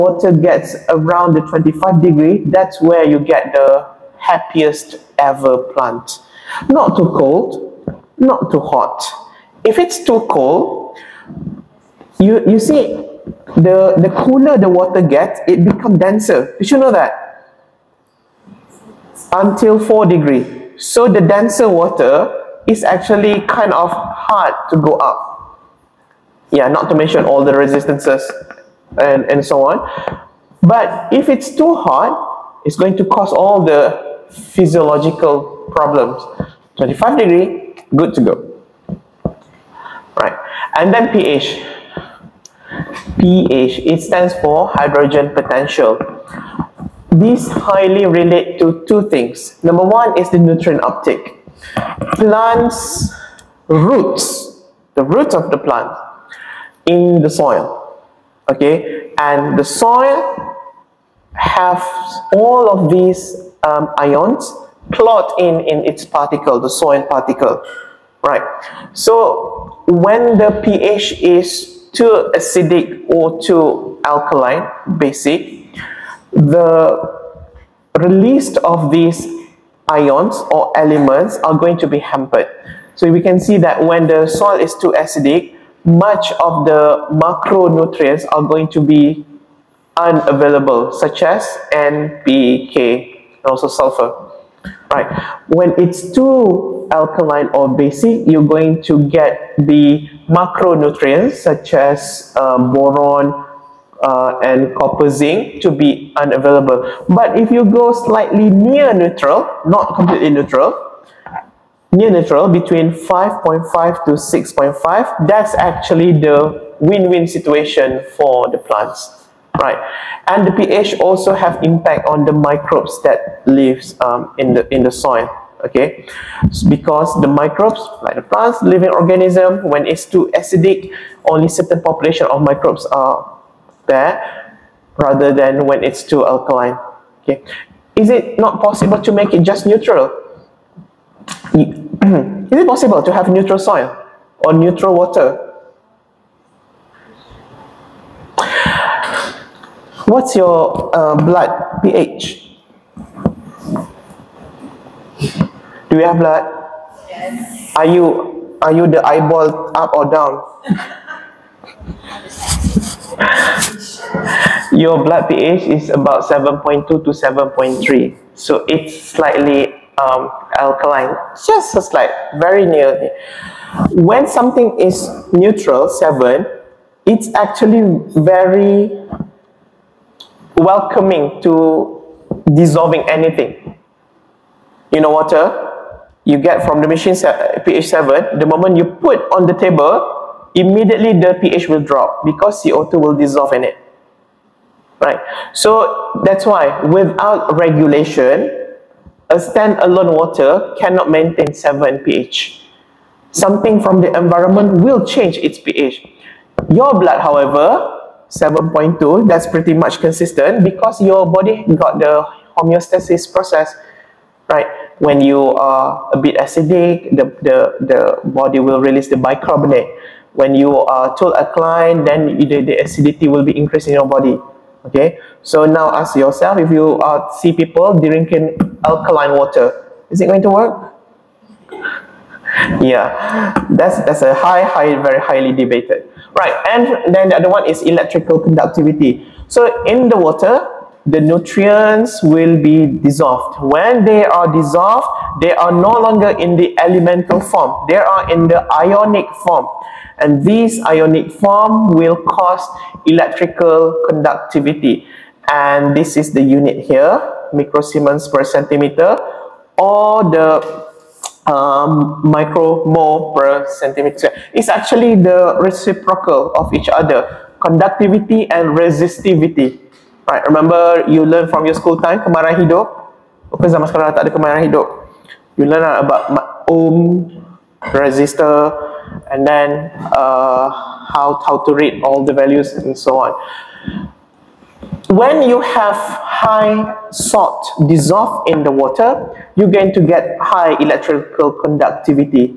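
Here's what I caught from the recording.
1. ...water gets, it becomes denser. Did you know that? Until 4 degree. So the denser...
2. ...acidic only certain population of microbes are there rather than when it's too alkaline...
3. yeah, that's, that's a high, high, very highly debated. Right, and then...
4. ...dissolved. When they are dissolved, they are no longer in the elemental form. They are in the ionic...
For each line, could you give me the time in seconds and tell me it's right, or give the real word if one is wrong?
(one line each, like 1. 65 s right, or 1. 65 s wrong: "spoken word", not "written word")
1. 14 s right
2. 130 s right
3. 232 s right
4. 243 s right.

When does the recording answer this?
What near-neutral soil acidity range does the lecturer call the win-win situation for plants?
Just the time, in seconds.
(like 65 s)
112 s.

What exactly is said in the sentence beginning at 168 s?
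So it's slightly um, alkaline, just a slight, very near.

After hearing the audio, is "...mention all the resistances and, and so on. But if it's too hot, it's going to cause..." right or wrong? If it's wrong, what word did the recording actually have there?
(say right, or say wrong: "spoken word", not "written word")
right.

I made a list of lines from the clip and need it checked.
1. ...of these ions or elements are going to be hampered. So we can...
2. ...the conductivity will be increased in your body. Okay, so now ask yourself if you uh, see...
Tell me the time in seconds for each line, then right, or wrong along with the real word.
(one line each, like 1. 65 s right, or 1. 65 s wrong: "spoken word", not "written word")
1. 78 s right
2. 222 s wrong: "acidity", not "conductivity".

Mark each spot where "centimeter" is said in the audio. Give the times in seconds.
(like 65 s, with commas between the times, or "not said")
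258 s, 263 s.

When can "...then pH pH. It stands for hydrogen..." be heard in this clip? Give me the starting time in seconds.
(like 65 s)
40 s.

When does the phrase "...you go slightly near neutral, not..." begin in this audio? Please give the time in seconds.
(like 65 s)
107 s.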